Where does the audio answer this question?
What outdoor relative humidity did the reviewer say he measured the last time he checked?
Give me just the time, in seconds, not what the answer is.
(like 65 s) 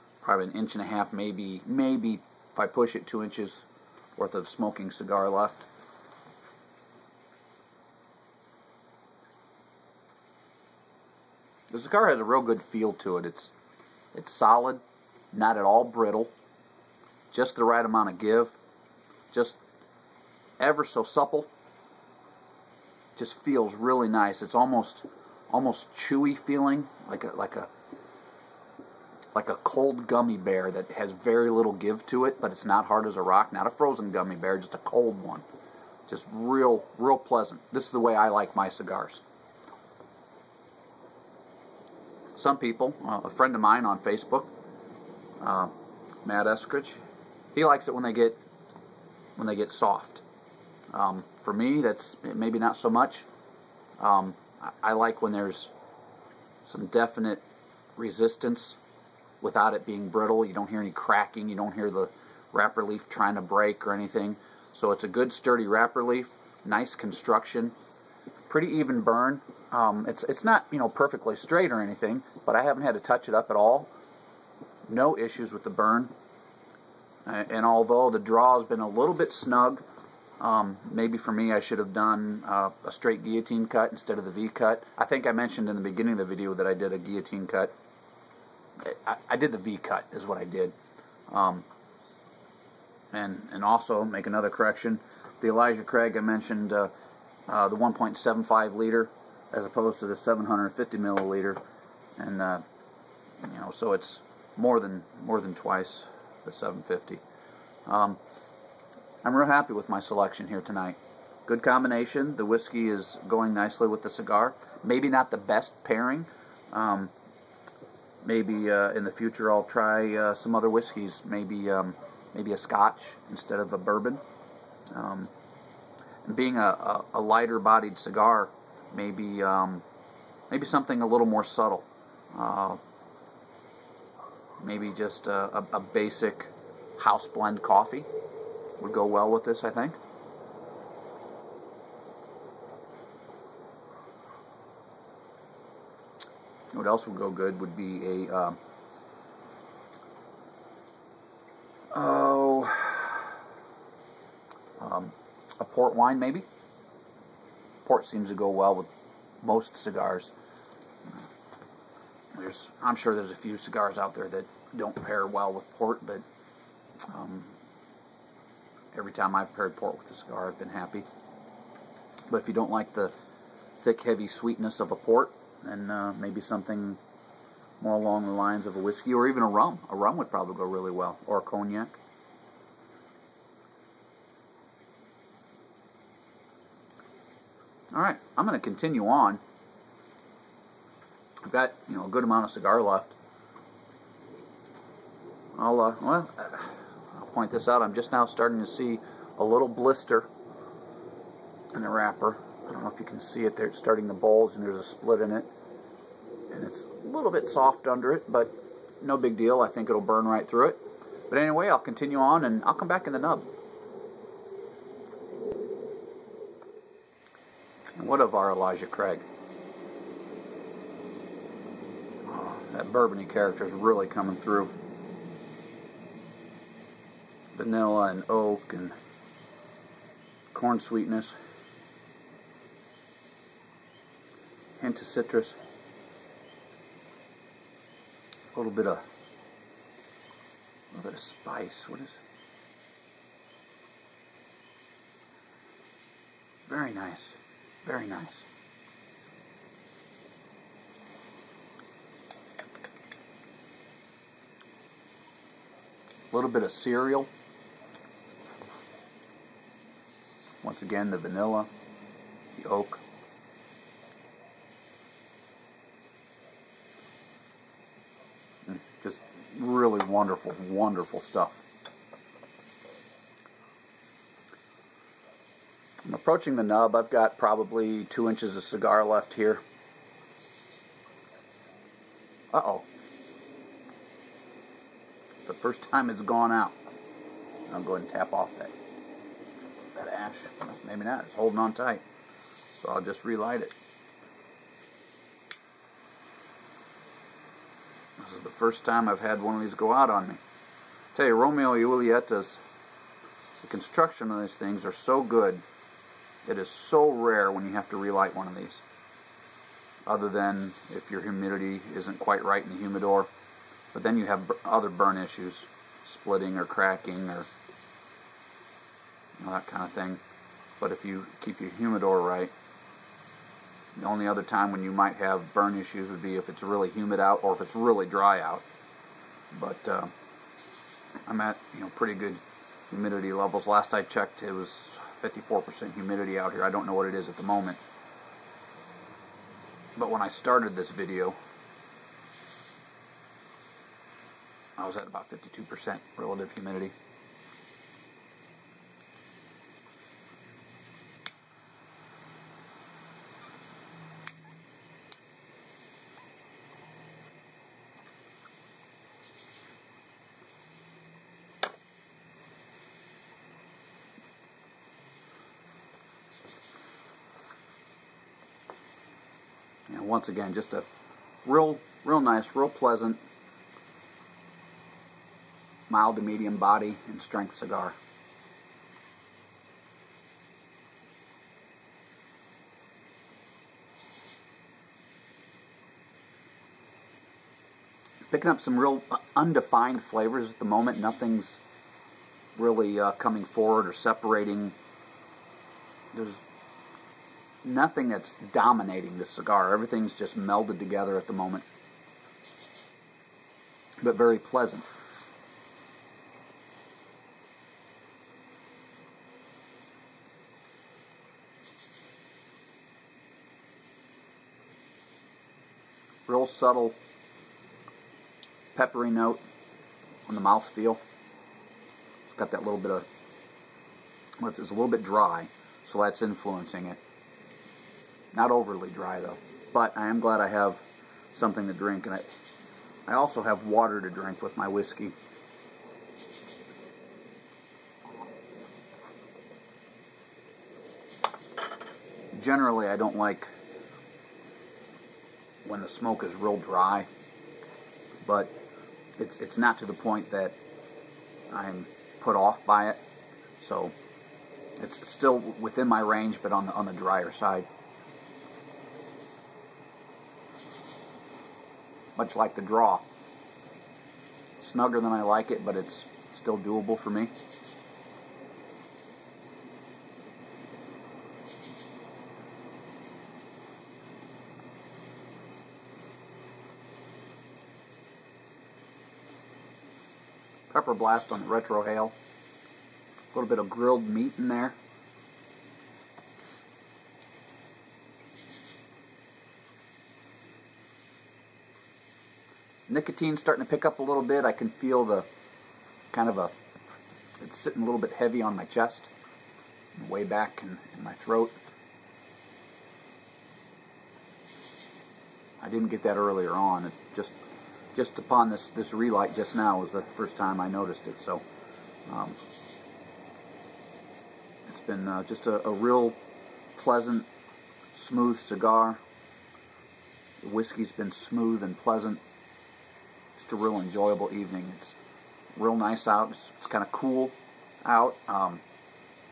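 335 s.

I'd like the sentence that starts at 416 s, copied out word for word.
Real subtle peppery note on the mouth feel.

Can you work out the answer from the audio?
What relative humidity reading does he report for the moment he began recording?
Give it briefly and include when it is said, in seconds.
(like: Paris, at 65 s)
52%, at 345 s.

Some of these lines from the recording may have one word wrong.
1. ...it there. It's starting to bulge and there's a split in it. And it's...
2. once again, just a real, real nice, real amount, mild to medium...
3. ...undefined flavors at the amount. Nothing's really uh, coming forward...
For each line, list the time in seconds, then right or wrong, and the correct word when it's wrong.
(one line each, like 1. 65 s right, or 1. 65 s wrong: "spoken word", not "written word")
1. 203 s right
2. 370 s wrong: "pleasant", not "amount"
3. 389 s wrong: "moment", not "amount".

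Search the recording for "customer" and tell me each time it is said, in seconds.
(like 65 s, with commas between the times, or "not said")
not said.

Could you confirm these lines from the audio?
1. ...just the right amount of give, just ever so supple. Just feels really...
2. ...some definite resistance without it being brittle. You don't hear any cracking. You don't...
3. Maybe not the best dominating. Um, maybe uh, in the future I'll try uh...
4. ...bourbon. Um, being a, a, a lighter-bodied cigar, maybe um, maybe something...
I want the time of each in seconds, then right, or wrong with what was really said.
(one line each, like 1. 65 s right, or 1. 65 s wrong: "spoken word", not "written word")
1. 17 s right
2. 56 s right
3. 114 s wrong: "pairing", not "dominating"
4. 123 s right.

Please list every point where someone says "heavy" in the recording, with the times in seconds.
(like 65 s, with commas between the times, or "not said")
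174 s, 498 s.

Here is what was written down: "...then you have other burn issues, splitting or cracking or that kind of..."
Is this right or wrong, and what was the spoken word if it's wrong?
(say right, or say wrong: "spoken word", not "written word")
right.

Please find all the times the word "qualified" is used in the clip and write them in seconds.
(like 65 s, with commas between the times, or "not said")
not said.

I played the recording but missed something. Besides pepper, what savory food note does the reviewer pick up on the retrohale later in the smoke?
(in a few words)
Grilled meat.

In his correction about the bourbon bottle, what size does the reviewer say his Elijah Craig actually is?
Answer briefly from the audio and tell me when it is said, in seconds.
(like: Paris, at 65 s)
1.75 liter, at 97 s.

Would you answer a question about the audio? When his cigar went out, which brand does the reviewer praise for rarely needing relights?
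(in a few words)
Romeo Julieta.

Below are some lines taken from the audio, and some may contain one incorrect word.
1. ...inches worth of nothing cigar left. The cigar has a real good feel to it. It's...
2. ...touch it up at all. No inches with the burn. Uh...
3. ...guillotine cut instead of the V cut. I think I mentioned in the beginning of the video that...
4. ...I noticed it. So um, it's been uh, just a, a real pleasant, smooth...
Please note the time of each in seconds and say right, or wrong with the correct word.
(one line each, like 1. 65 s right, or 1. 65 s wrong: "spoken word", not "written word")
1. 3 s wrong: "smoking", not "nothing"
2. 73 s wrong: "issues", not "inches"
3. 83 s right
4. 510 s right.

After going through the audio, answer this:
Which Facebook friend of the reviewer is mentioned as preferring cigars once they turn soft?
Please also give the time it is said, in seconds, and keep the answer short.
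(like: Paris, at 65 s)
Matt Eskridge, at 46 s.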